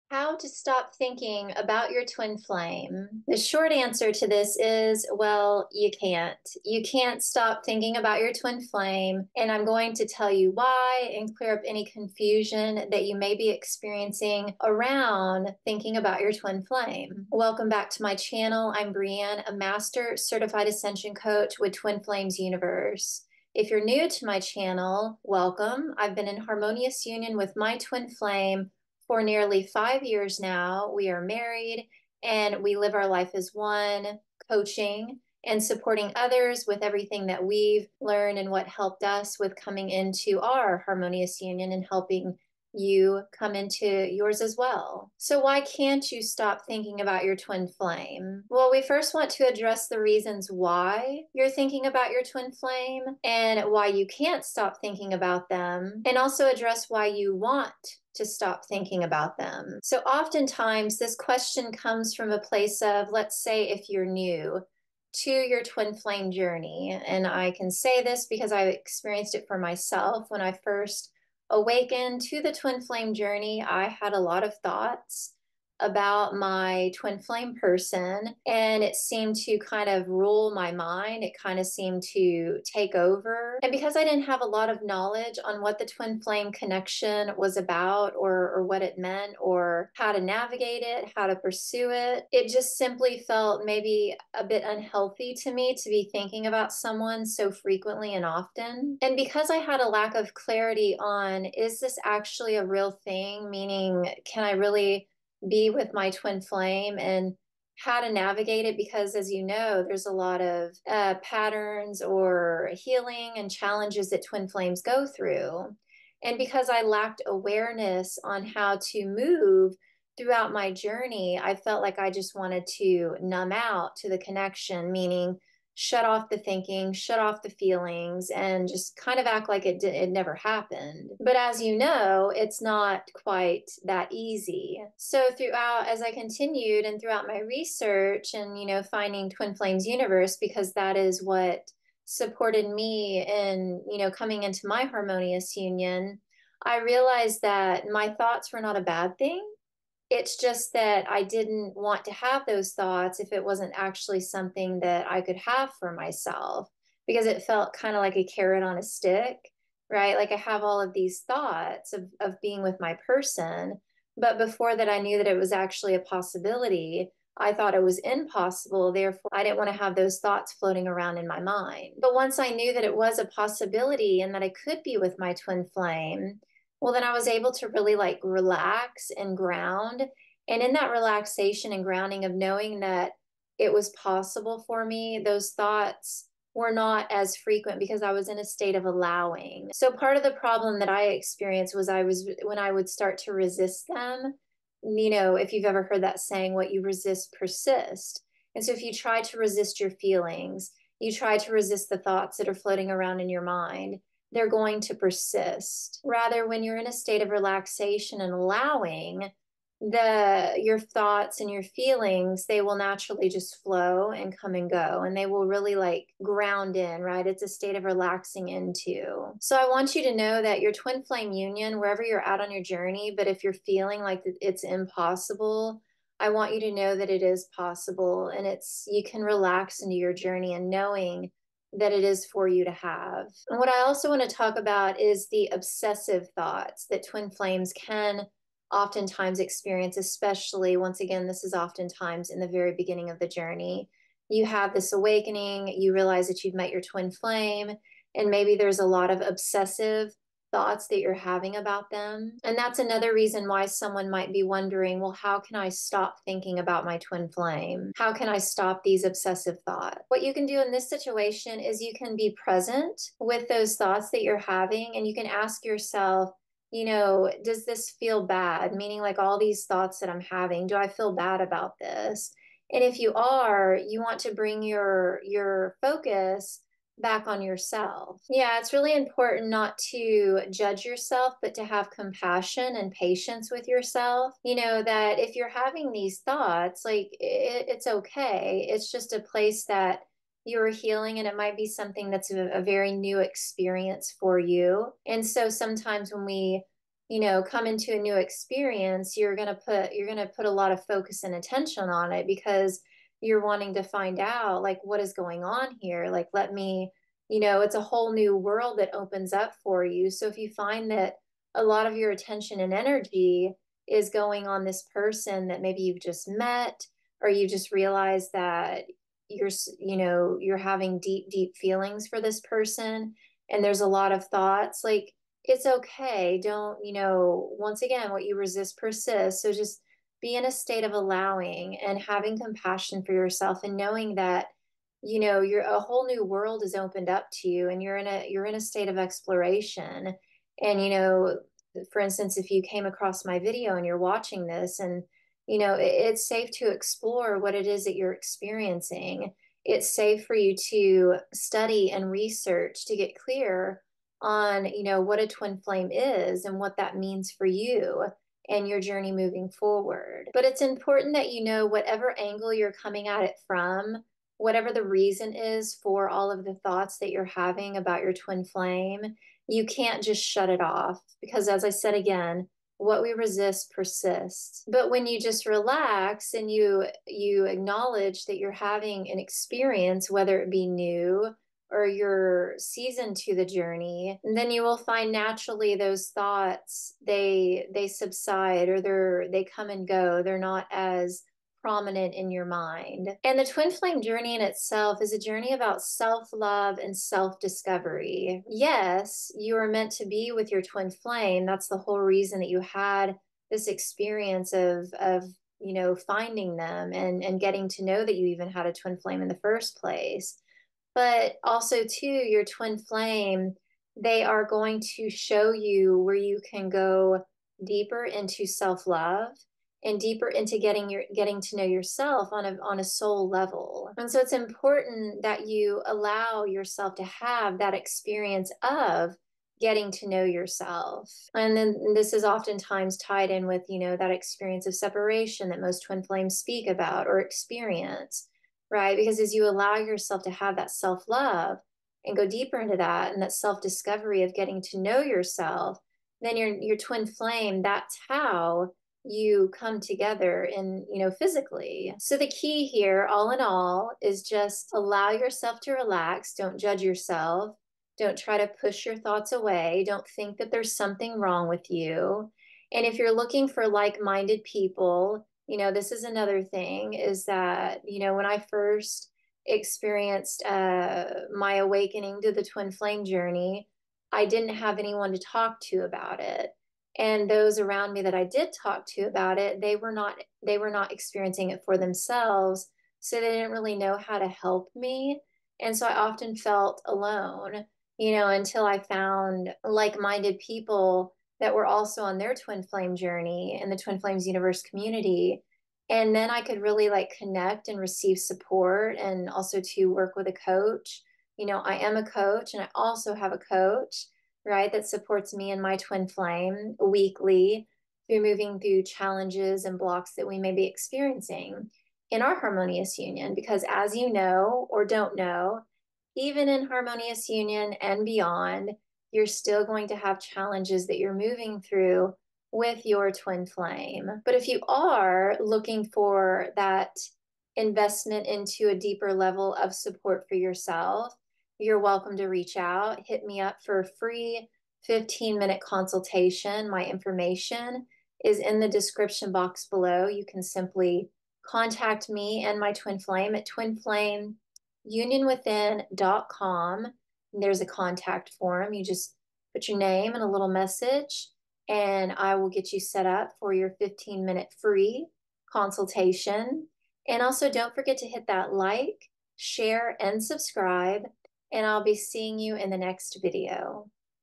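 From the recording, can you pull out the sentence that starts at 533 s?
Hit me up for a free 15 minute consultation.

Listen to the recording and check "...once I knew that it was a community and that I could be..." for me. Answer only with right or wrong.
wrong.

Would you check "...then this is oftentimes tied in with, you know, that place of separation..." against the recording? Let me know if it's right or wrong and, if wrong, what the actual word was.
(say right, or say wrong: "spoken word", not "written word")
wrong: "experience", not "place".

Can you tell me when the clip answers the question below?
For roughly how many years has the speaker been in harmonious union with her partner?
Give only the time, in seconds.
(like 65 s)
29 s.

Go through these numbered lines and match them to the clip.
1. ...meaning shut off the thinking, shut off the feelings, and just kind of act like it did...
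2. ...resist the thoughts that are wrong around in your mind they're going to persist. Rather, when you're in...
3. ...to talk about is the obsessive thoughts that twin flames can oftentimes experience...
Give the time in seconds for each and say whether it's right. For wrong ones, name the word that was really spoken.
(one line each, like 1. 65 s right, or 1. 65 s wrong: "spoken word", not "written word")
1. 124 s right
2. 201 s wrong: "floating", not "wrong"
3. 234 s right.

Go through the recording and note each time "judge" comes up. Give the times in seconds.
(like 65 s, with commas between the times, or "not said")
280 s, 456 s.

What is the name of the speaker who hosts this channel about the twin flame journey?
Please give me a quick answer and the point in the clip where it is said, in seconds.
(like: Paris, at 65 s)
Breann, at 18 s.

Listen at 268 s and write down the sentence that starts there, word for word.
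Meaning, like all these thoughts that I'm having, do I feel bad about this?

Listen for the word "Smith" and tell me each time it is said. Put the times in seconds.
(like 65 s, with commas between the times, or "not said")
not said.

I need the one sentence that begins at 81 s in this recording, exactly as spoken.
It kind of seemed to take over.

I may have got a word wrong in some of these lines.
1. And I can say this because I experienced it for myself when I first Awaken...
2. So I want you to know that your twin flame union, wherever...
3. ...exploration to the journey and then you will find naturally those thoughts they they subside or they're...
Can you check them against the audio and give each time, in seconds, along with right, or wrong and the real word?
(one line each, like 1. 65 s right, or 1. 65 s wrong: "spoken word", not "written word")
1. 67 s right
2. 219 s right
3. 382 s wrong: "season", not "exploration".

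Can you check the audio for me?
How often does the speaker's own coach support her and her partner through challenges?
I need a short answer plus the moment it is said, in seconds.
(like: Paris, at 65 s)
Weekly, at 506 s.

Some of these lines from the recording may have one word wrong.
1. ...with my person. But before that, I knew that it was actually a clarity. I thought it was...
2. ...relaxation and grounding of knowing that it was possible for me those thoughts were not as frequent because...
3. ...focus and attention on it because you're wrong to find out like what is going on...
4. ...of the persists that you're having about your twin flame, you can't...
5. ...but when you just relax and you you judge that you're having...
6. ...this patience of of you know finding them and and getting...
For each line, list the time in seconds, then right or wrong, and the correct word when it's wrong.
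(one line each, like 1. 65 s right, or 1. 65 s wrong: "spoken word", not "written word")
1. 162 s wrong: "possibility", not "clarity"
2. 180 s right
3. 300 s wrong: "wanting", not "wrong"
4. 366 s wrong: "thoughts", not "persists"
5. 374 s wrong: "acknowledge", not "judge"
6. 403 s wrong: "experience", not "patience".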